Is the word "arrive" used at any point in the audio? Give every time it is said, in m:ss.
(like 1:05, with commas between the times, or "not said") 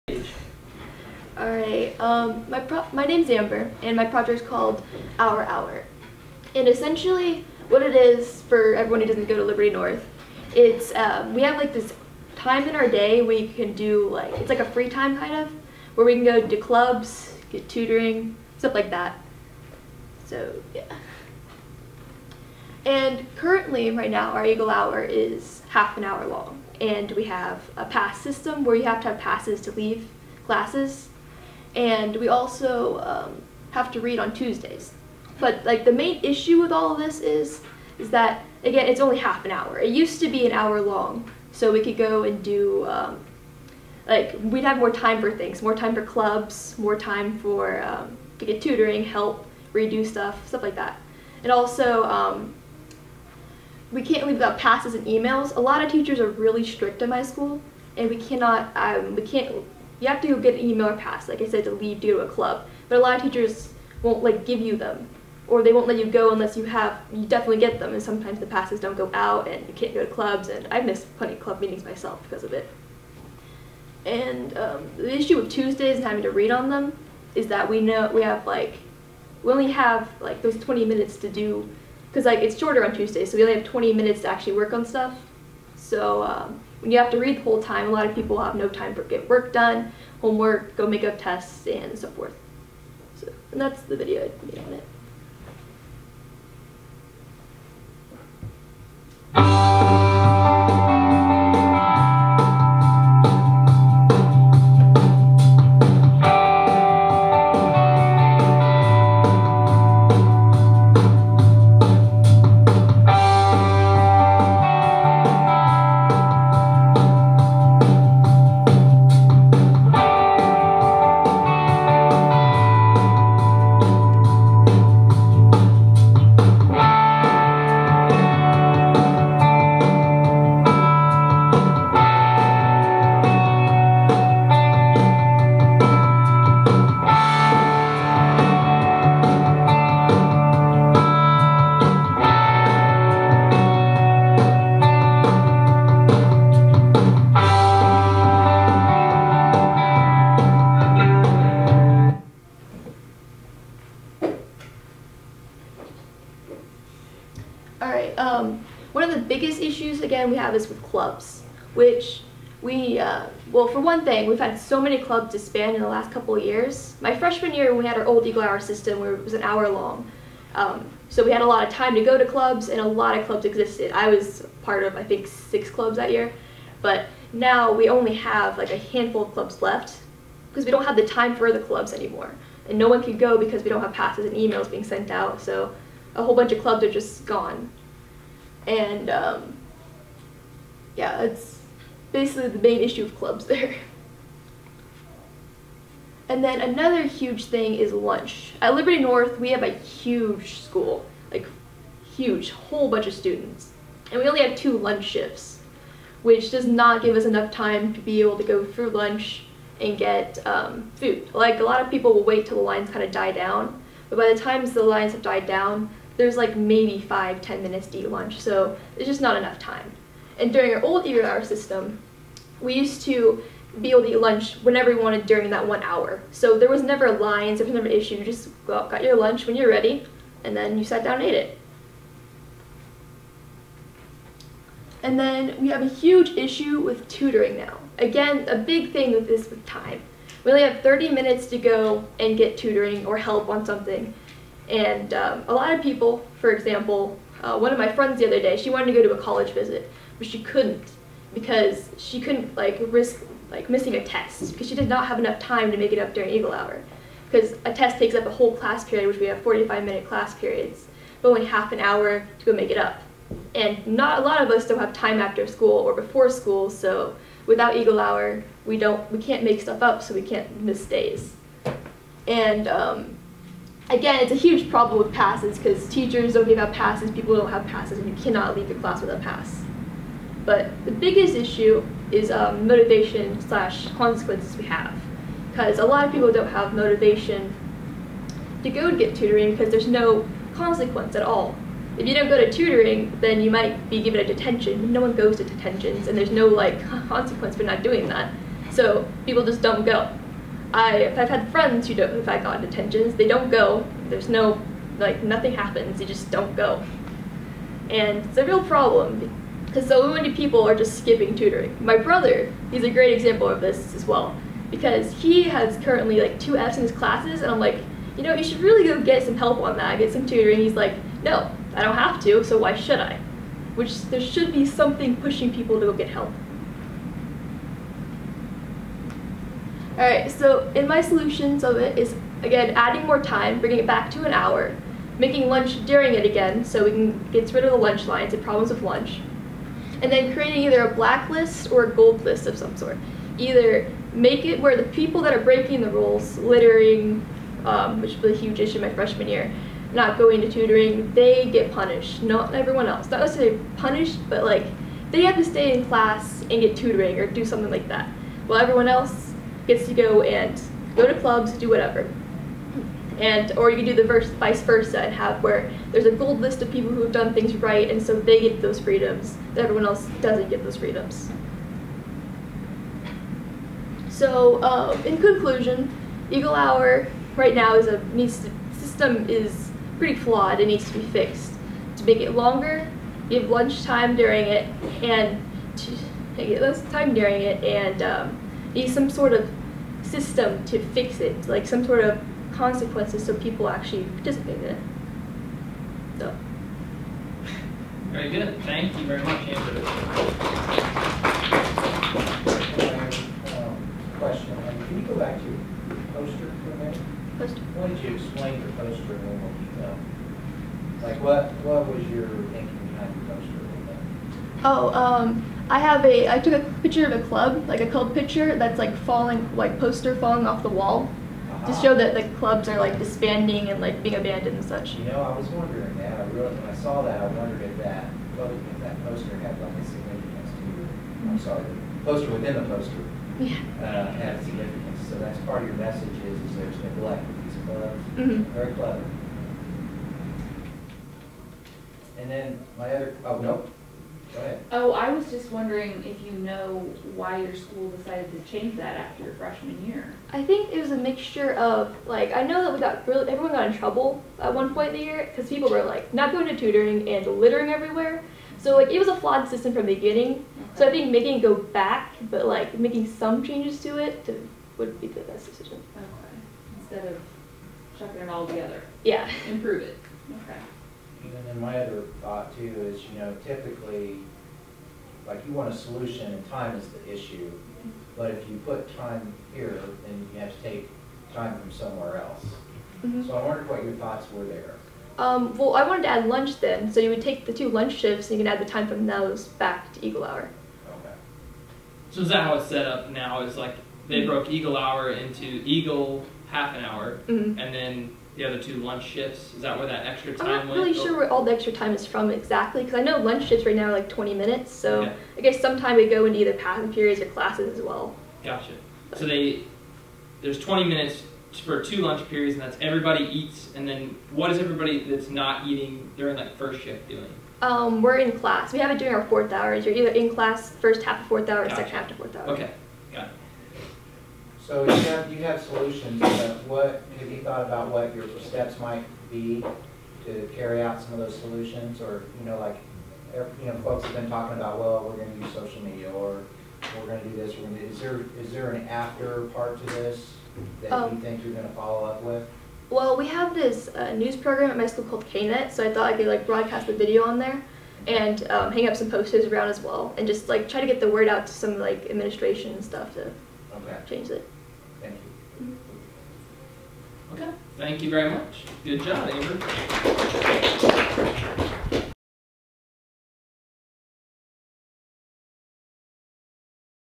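not said.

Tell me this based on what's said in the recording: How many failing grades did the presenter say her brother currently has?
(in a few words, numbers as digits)
2.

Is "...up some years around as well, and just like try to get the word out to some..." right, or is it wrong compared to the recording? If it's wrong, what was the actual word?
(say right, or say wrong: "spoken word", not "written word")
wrong: "posters", not "years".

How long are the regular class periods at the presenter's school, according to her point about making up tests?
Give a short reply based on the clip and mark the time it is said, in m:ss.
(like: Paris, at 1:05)
45 minutes, at 4:19.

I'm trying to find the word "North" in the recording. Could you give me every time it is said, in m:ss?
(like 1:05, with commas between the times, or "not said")
0:09, 3:18.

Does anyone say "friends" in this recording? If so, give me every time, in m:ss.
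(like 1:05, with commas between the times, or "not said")
4:07, 5:01.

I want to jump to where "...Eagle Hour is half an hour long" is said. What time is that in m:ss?
0:24.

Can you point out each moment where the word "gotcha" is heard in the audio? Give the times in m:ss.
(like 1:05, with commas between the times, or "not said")
8:28, 8:41.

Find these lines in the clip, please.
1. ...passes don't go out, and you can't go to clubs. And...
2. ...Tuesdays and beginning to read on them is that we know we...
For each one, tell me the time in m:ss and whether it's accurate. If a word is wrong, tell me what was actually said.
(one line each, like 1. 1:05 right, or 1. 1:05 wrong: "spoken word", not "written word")
1. 1:08 right
2. 1:15 wrong: "having", not "beginning".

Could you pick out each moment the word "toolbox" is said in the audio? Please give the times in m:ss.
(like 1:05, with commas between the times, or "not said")
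not said.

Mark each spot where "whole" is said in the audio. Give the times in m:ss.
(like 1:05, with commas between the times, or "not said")
1:27, 3:06, 3:22, 4:18.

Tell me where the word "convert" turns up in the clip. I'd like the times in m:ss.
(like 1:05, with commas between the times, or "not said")
not said.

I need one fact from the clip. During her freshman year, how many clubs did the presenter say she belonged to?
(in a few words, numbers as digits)
6.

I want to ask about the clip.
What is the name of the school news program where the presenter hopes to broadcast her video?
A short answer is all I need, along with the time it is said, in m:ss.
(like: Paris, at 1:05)
KNET, at 9:05.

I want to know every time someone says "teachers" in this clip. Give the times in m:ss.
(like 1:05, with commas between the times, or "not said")
0:55, 1:03, 4:35.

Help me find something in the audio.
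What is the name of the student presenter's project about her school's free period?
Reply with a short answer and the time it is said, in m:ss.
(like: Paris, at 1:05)
Our Hour, at 0:05.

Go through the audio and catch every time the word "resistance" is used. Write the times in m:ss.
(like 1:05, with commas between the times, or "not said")
not said.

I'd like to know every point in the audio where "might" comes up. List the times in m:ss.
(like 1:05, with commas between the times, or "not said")
4:53, 8:48.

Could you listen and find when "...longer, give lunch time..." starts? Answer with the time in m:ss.
6:22.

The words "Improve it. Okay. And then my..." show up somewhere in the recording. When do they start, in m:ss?
7:49.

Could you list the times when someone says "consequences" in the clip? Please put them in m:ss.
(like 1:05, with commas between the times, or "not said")
4:43, 4:50, 4:57, 6:32.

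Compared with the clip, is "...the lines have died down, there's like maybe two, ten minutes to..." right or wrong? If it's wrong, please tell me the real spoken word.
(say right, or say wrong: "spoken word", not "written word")
wrong: "five", not "two".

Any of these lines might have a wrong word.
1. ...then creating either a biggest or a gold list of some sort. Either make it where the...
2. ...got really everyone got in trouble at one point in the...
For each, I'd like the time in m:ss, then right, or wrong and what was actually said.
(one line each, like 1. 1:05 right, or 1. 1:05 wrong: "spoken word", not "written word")
1. 5:40 wrong: "blacklist", not "biggest"
2. 7:32 right.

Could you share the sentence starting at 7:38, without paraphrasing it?
So like it was a flawed system from the beginning.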